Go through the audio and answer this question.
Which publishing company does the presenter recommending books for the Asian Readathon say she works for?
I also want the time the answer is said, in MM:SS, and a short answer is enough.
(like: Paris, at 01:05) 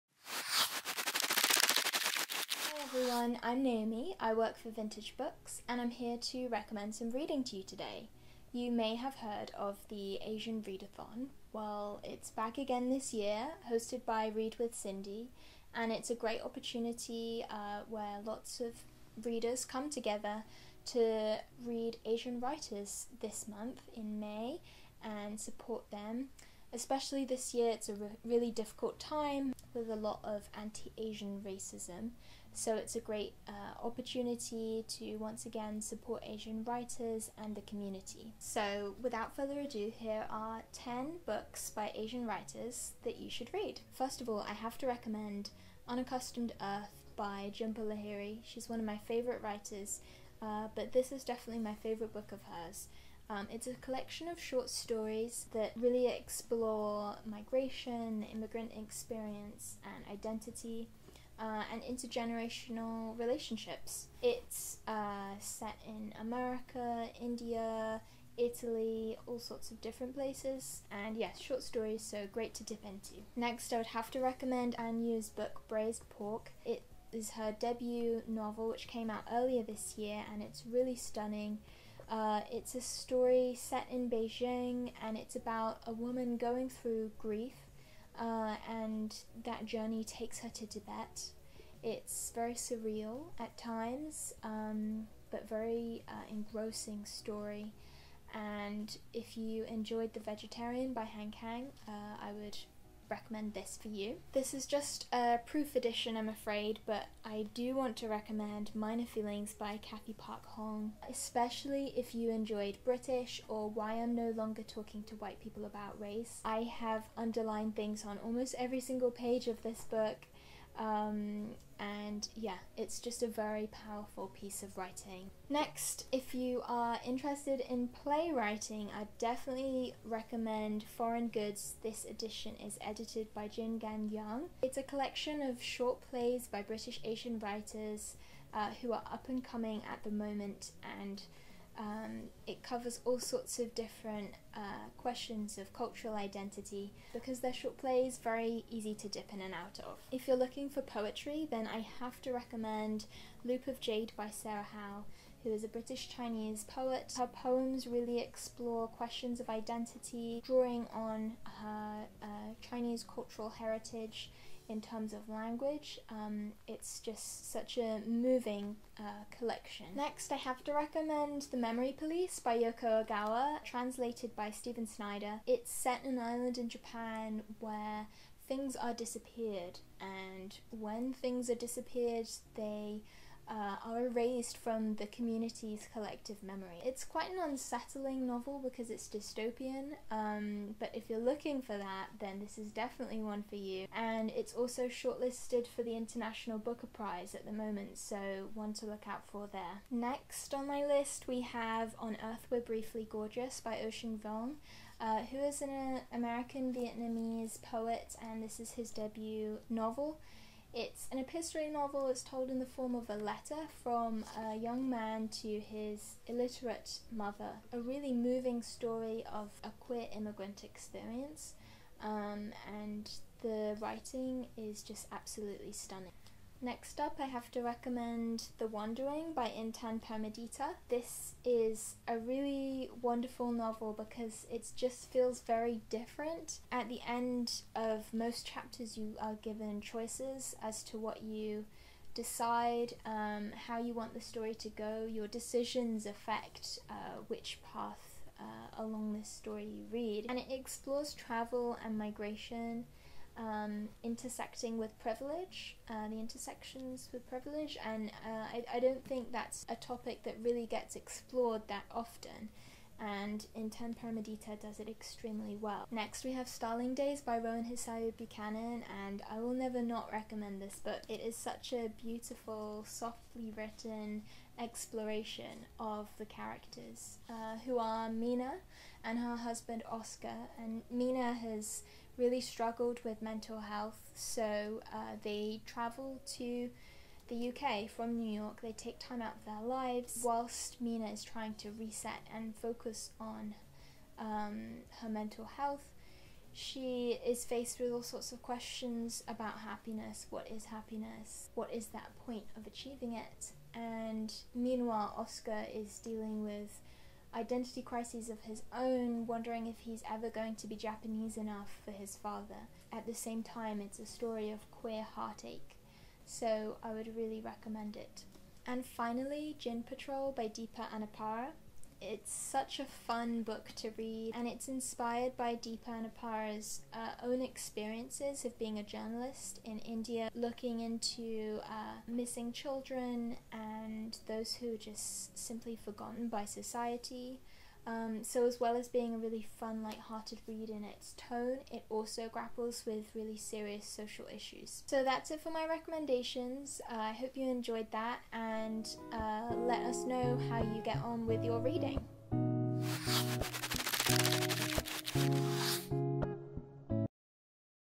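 Vintage Books, at 00:04.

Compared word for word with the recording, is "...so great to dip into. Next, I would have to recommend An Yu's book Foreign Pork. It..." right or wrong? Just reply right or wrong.
wrong.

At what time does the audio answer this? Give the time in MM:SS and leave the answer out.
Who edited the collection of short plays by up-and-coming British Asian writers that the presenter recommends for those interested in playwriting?
02:13.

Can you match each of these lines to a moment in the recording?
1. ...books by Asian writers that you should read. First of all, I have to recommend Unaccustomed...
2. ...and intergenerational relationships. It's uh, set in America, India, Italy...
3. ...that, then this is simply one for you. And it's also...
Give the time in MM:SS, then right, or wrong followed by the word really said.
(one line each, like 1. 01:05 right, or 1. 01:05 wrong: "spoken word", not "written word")
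1. 00:41 right
2. 01:01 right
3. 03:11 wrong: "definitely", not "simply".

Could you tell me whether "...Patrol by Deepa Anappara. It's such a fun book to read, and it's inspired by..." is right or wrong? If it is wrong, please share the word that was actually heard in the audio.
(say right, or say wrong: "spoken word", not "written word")
right.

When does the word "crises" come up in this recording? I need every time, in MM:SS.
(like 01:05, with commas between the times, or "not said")
05:07.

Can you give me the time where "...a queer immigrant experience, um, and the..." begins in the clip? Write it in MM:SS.
03:39.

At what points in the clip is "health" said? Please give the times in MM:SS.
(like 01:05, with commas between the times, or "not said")
04:43, 04:55.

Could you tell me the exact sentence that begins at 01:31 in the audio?
It's very surreal at times, um, but very uh, engrossing story.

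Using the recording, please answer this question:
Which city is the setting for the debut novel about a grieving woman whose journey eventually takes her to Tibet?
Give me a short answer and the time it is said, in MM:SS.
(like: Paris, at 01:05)
Beijing, at 01:24.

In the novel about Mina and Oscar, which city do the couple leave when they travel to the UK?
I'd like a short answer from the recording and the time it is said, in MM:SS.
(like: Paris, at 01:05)
New York, at 04:48.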